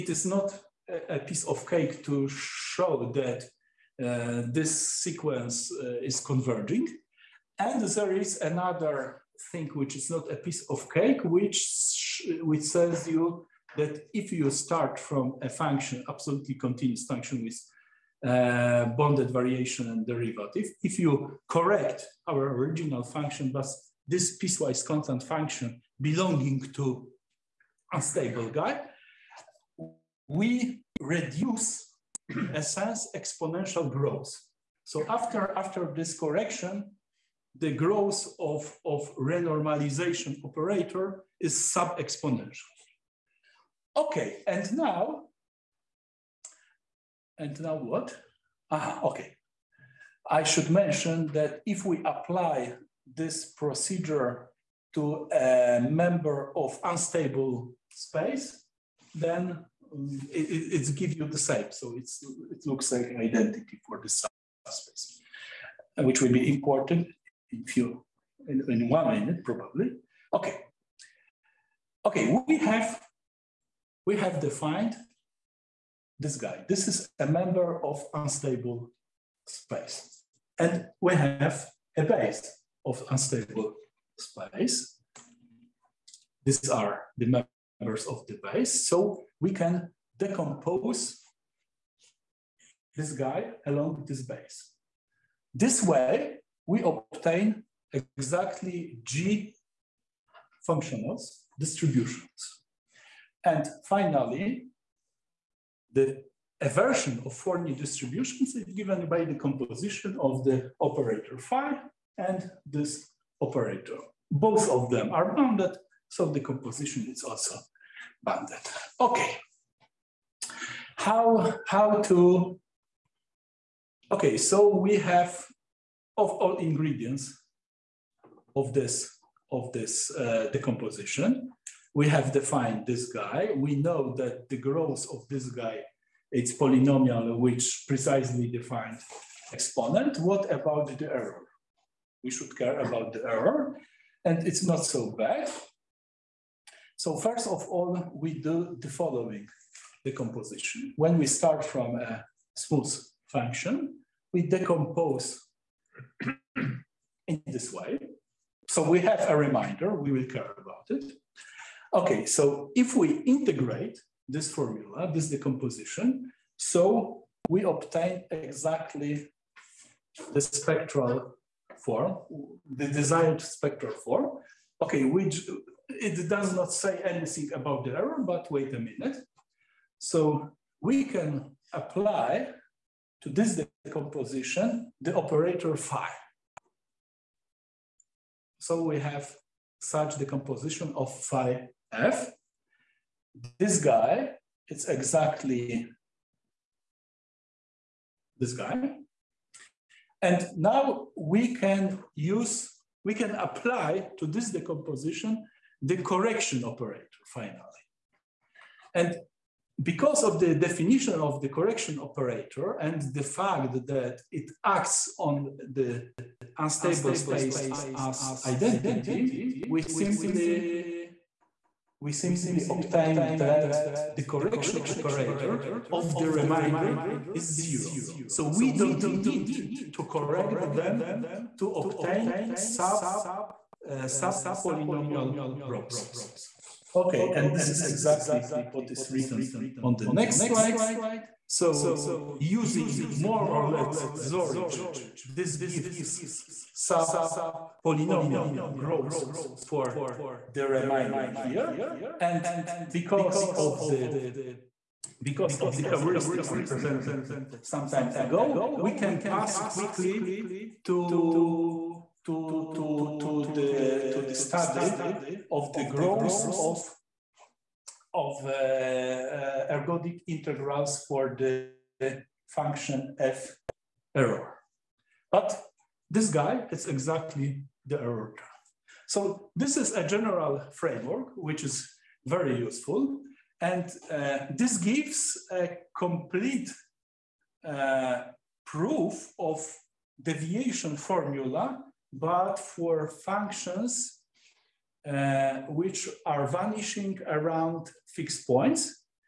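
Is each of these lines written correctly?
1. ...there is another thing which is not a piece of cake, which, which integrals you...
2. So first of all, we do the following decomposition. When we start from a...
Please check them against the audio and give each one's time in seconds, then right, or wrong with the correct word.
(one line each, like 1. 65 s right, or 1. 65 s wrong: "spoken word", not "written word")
1. 7 s wrong: "tells", not "integrals"
2. 146 s right.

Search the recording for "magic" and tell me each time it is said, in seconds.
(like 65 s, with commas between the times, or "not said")
not said.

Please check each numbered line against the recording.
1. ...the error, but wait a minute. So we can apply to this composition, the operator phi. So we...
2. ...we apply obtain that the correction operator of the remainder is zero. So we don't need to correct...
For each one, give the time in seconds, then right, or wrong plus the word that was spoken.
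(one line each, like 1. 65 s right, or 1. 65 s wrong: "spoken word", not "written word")
1. 177 s right
2. 221 s wrong: "simply", not "apply".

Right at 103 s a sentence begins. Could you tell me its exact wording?
And finally, the aversion of Forni distributions is given by the composition of the operator phi and this operator.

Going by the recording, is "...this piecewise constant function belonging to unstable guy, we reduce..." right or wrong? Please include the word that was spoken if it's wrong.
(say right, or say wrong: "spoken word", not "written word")
right.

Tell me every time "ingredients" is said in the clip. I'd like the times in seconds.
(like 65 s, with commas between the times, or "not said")
126 s.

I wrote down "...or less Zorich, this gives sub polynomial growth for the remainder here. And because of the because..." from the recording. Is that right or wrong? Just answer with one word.
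right.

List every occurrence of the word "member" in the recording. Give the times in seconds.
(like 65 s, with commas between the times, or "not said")
55 s, 77 s, 87 s.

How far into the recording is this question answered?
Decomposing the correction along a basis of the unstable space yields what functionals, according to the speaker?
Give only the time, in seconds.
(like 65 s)
99 s.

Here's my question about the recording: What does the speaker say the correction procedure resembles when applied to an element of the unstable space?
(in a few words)
an identity.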